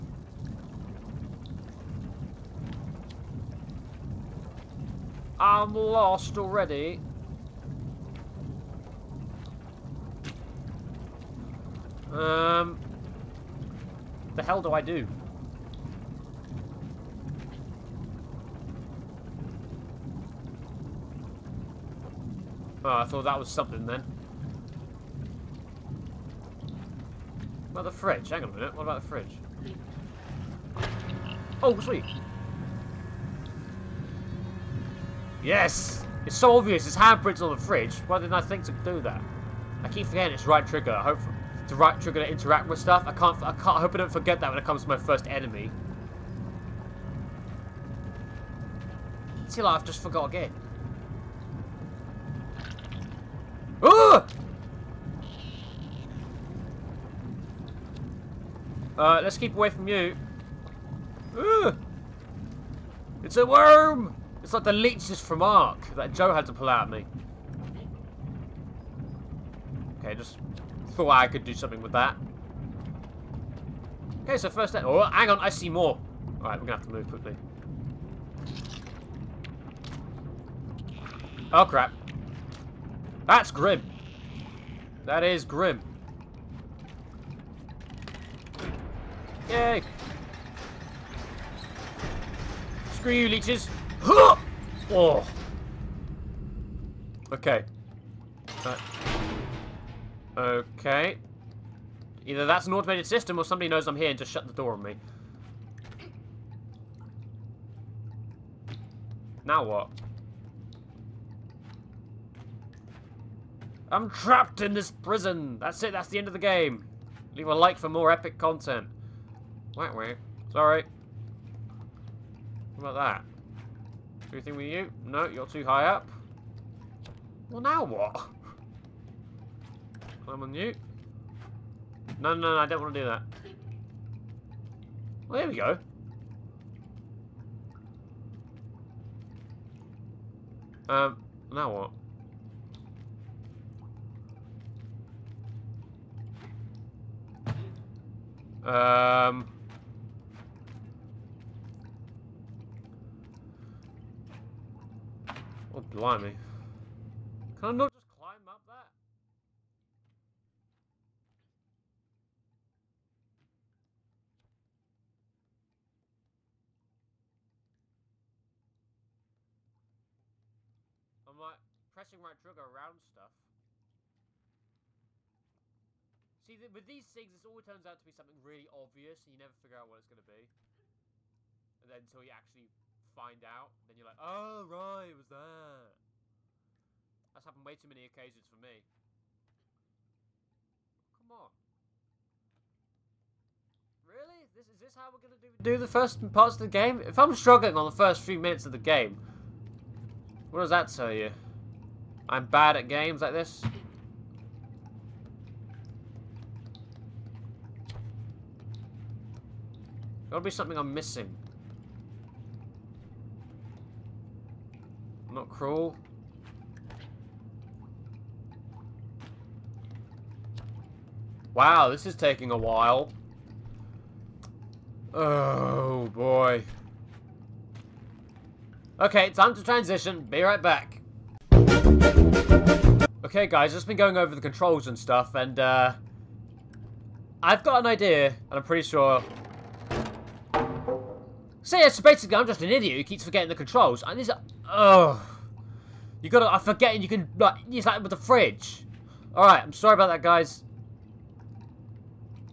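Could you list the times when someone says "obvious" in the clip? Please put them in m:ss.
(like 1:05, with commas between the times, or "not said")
0:36, 2:58.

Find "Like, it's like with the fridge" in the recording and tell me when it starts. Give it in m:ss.
4:07.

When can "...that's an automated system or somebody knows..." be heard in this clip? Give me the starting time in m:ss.
1:42.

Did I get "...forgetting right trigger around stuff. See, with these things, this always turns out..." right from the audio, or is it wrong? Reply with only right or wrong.
wrong.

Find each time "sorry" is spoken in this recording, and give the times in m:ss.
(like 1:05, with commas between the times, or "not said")
2:00, 4:09.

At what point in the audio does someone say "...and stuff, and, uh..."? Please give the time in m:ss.
3:54.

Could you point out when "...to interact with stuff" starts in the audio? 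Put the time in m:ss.
0:42.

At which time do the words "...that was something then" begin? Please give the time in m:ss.
0:23.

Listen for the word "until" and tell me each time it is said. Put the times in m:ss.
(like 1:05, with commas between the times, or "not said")
3:01.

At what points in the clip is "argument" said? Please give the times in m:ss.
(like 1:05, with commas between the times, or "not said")
not said.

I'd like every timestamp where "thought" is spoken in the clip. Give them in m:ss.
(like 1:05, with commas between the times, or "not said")
0:23, 1:11.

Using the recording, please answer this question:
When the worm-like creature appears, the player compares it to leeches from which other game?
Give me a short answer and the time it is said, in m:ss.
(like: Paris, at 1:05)
Ark, at 1:05.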